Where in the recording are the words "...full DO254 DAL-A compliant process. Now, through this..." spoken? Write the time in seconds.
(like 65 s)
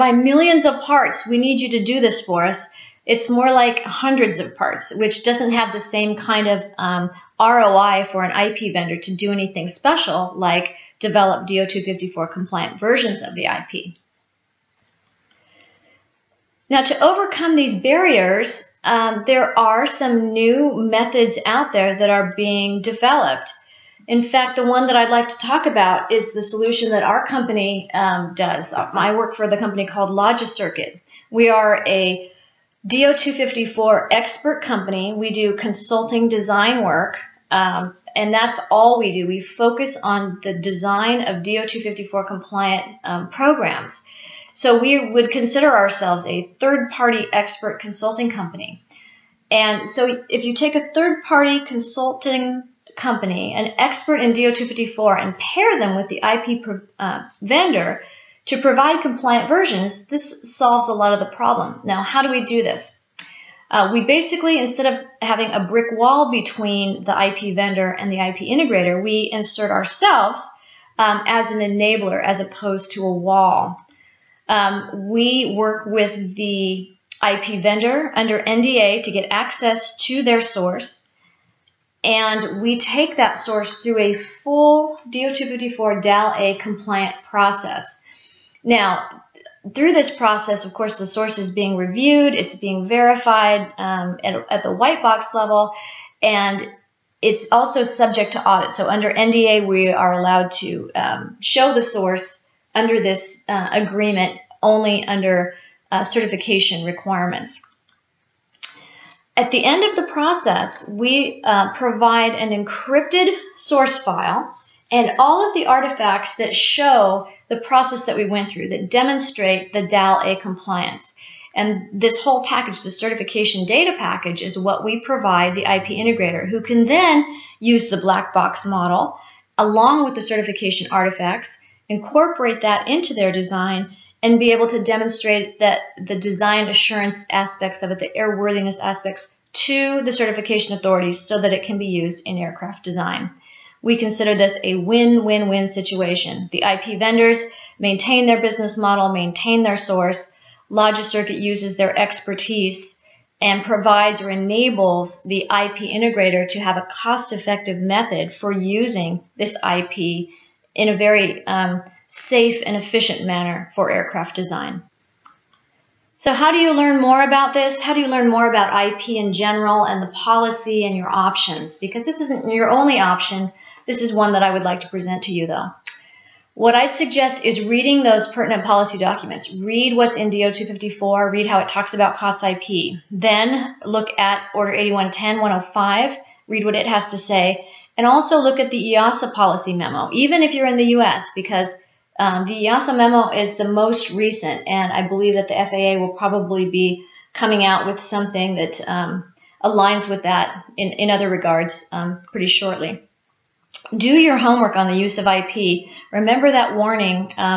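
84 s.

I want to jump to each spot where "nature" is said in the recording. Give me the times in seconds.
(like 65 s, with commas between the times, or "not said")
not said.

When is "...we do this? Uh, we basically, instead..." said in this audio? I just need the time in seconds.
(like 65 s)
62 s.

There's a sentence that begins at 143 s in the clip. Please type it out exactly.
We consider this a win-win-win situation.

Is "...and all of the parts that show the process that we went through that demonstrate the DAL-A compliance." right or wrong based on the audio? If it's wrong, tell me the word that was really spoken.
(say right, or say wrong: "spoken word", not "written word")
wrong: "artifacts", not "parts".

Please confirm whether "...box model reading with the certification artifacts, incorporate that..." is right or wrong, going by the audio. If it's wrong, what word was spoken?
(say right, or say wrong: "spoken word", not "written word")
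wrong: "along", not "reading".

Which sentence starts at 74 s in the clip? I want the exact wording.
Um, we work with the IP vendor under NDA to get access to their source.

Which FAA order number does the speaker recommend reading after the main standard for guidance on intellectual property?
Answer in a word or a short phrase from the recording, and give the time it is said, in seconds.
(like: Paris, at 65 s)
Order 8110-105, at 184 s.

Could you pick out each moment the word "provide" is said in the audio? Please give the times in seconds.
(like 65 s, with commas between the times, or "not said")
58 s, 111 s, 125 s, 153 s.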